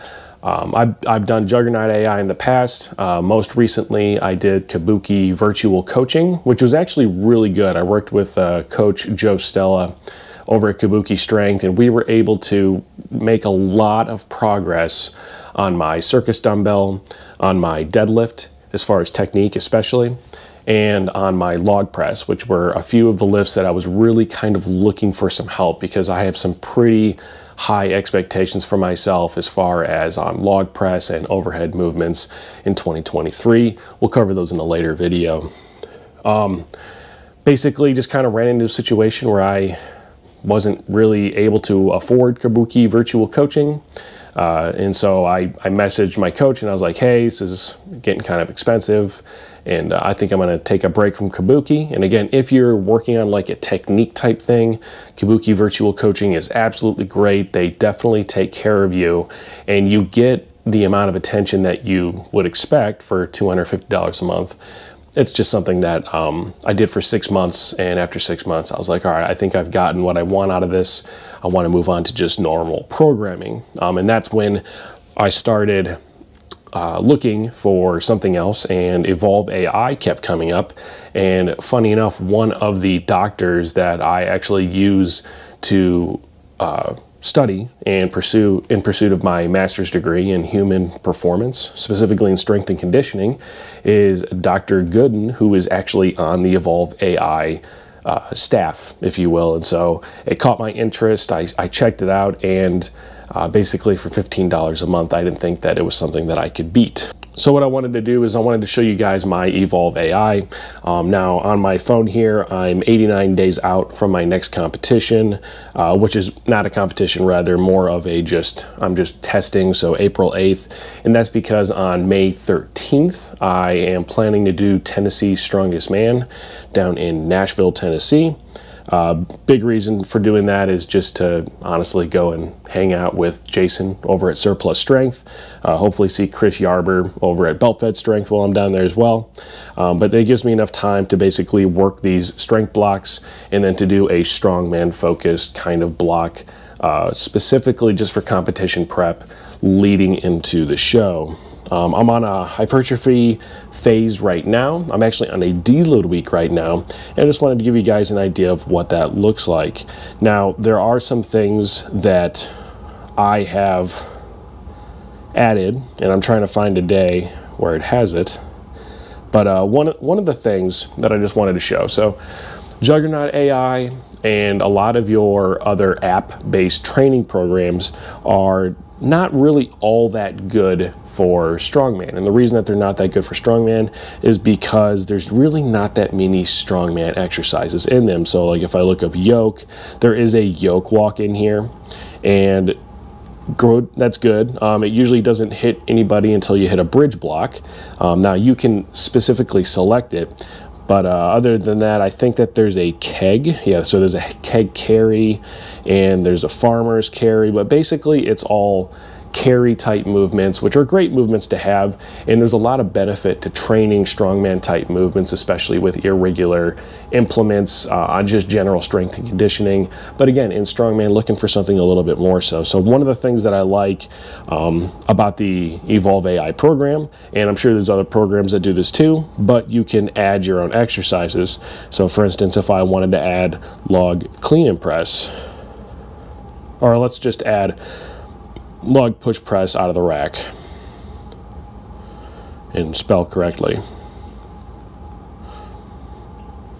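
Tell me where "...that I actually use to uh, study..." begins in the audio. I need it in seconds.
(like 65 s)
83 s.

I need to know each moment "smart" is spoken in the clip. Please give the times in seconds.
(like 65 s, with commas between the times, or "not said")
not said.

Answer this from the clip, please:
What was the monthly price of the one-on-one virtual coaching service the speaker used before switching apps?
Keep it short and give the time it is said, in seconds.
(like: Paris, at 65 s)
$250, at 63 s.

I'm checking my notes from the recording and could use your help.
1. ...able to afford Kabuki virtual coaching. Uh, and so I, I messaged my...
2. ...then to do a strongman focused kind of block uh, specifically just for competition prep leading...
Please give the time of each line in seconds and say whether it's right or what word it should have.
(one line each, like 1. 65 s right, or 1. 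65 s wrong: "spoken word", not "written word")
1. 41 s right
2. 143 s right.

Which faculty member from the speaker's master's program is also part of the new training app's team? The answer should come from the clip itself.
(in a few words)
Dr. Gooden.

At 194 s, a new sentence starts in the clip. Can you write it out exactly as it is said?
Um, it usually doesn't hit anybody until you hit a bridge block.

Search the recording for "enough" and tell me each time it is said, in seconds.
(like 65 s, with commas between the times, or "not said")
81 s, 140 s.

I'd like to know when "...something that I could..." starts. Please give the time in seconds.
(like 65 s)
105 s.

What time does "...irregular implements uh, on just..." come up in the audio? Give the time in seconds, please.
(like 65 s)
216 s.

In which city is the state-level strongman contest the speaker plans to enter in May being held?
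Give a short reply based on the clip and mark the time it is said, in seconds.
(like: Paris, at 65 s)
Nashville, at 127 s.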